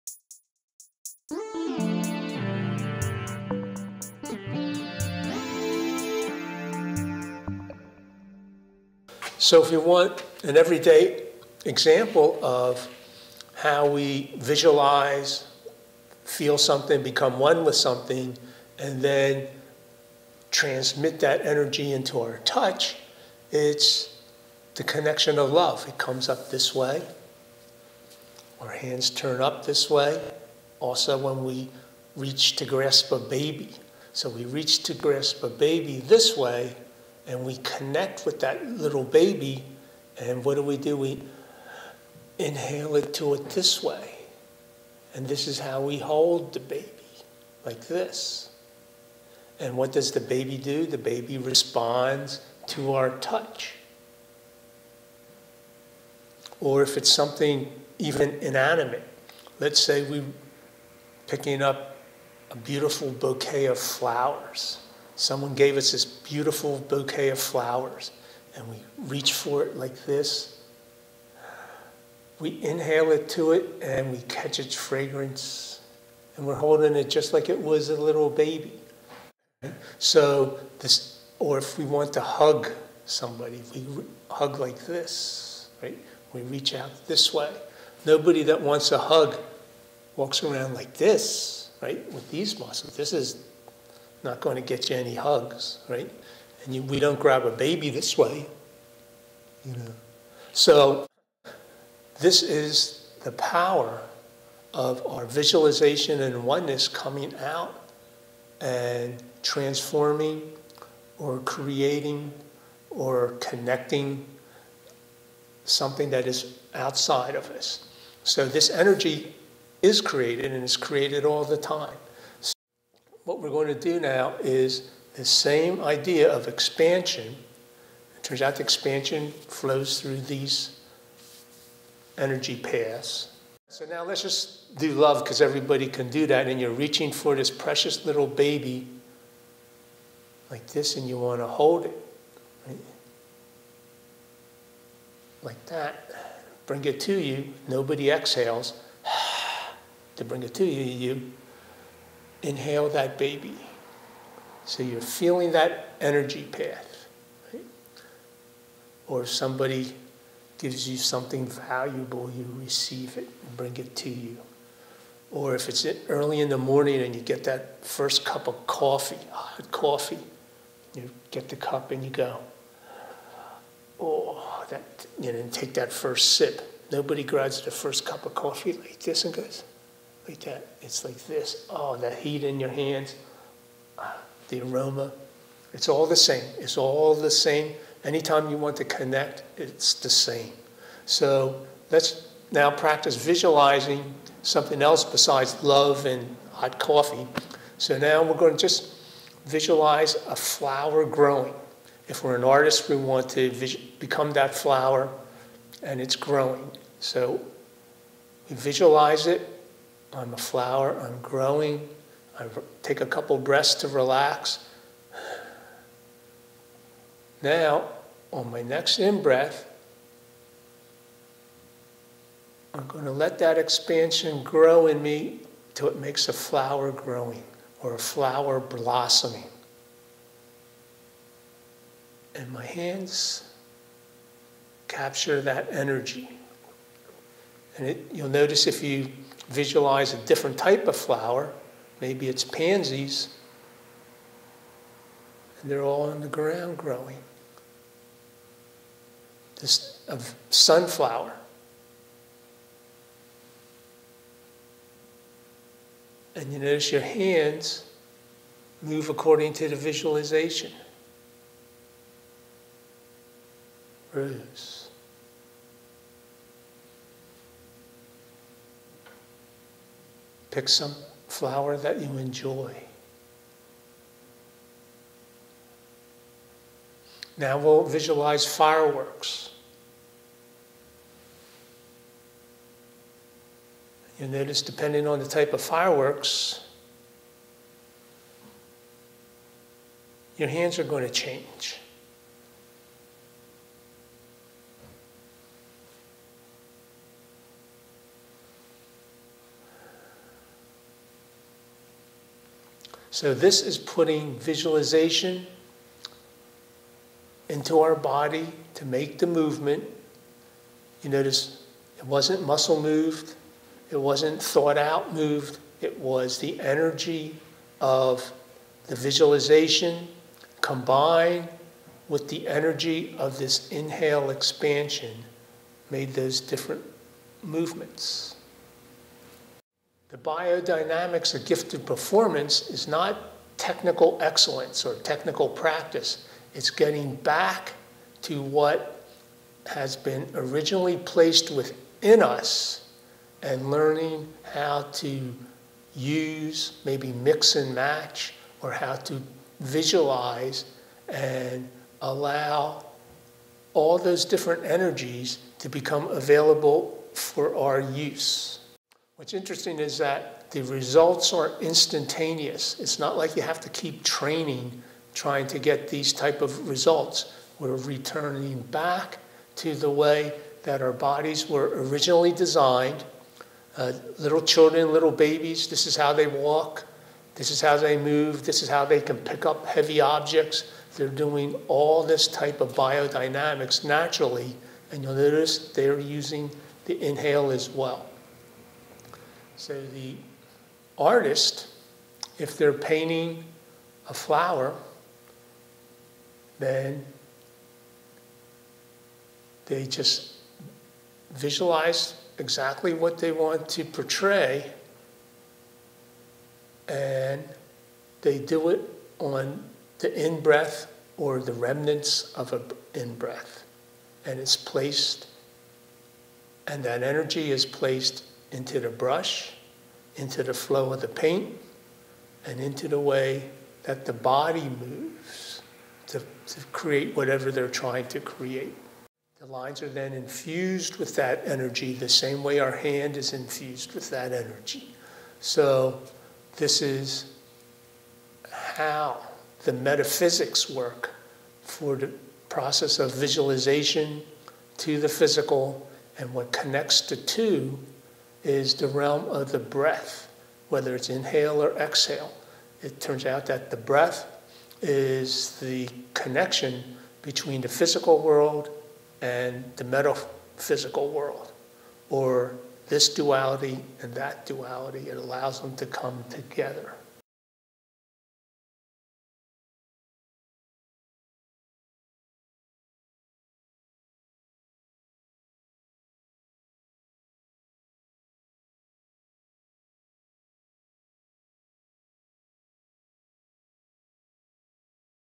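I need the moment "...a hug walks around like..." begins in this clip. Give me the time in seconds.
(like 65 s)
88 s.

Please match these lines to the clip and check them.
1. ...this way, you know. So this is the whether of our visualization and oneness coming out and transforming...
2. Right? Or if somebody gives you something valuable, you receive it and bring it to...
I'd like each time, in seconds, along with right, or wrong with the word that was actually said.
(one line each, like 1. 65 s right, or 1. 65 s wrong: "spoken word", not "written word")
1. 97 s wrong: "power", not "whether"
2. 157 s right.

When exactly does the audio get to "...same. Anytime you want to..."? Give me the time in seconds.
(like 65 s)
187 s.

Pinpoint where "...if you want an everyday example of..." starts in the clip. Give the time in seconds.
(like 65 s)
9 s.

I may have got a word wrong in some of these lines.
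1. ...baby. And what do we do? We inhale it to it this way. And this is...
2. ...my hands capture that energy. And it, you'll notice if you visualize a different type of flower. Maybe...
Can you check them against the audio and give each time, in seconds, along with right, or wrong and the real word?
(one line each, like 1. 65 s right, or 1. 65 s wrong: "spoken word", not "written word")
1. 39 s right
2. 232 s right.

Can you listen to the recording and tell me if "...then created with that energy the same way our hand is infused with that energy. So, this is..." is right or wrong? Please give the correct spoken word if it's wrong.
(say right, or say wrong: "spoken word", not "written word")
wrong: "infused", not "created".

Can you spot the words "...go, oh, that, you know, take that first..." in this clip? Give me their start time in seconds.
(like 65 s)
172 s.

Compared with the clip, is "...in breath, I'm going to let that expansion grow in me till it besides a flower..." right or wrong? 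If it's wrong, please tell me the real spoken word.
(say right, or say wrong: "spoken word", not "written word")
wrong: "makes", not "besides".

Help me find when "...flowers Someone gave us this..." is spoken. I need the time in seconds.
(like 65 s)
63 s.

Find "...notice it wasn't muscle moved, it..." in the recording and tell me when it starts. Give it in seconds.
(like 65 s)
311 s.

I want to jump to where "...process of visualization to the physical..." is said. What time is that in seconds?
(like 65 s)
442 s.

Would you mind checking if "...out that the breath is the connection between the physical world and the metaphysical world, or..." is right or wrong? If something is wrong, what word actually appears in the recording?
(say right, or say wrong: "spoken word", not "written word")
right.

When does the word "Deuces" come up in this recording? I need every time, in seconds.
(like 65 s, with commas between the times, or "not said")
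not said.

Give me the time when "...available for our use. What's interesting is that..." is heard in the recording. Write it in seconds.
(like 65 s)
356 s.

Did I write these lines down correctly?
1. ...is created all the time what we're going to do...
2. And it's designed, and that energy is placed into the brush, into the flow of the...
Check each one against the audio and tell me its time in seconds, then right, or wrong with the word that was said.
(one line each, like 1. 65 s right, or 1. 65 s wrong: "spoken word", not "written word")
1. 120 s right
2. 414 s wrong: "placed", not "designed".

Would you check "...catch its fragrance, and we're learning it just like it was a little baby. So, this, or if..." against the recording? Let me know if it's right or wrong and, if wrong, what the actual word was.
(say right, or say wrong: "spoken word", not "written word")
wrong: "holding", not "learning".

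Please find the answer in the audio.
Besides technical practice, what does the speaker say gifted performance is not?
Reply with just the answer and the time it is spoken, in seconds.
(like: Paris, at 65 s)
technical excellence, at 333 s.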